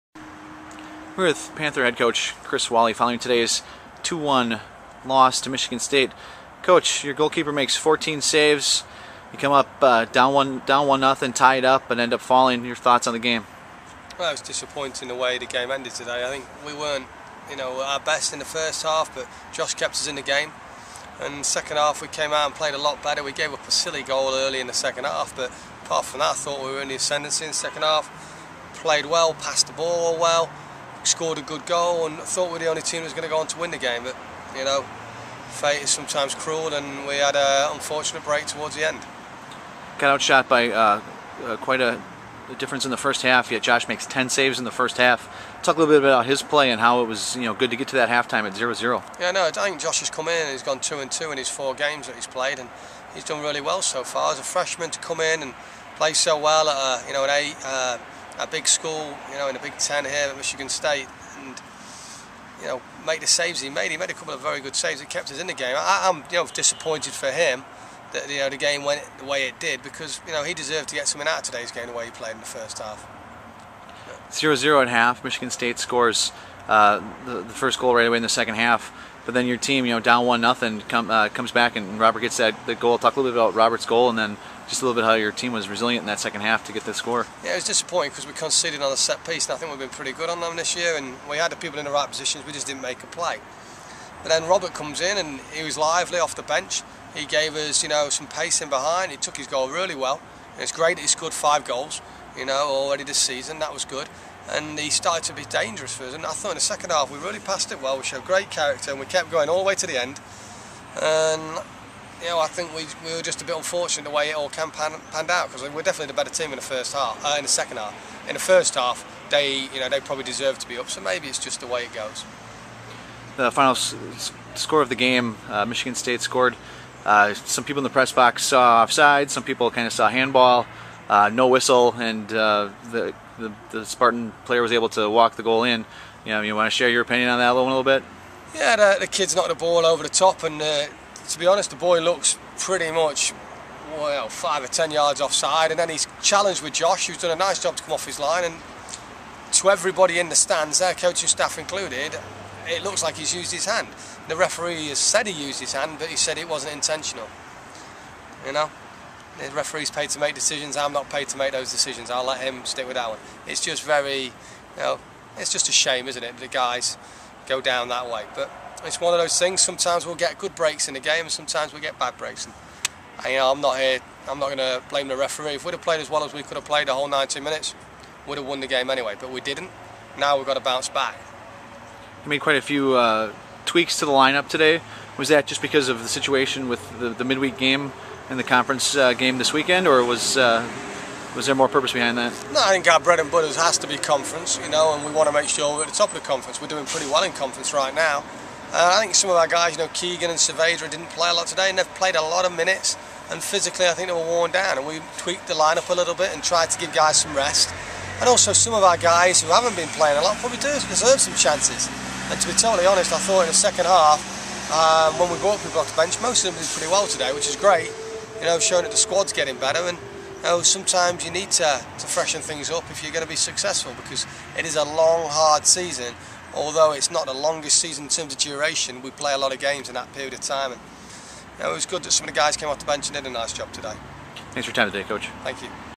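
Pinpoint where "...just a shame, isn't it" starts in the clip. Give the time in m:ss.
2:45.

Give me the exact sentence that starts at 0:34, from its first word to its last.
But, you know, fate is sometimes cruel and we had an unfortunate break towards the end.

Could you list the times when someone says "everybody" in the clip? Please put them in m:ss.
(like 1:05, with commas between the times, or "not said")
2:29.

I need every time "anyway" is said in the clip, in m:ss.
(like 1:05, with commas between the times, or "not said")
2:58.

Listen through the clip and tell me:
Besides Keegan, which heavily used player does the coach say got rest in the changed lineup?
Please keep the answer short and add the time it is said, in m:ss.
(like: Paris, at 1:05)
Saavedra, at 3:20.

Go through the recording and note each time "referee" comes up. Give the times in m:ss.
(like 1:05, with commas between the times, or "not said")
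2:34, 2:39, 2:55.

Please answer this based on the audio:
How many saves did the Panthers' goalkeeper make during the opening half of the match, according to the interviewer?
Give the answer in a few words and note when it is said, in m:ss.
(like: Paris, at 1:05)
10, at 0:44.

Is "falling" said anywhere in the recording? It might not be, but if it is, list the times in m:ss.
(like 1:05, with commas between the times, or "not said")
0:12.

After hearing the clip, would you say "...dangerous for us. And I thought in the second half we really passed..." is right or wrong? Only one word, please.
right.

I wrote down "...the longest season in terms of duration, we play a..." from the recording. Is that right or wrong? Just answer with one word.
right.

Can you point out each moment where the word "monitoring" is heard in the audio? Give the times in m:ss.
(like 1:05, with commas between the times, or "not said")
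not said.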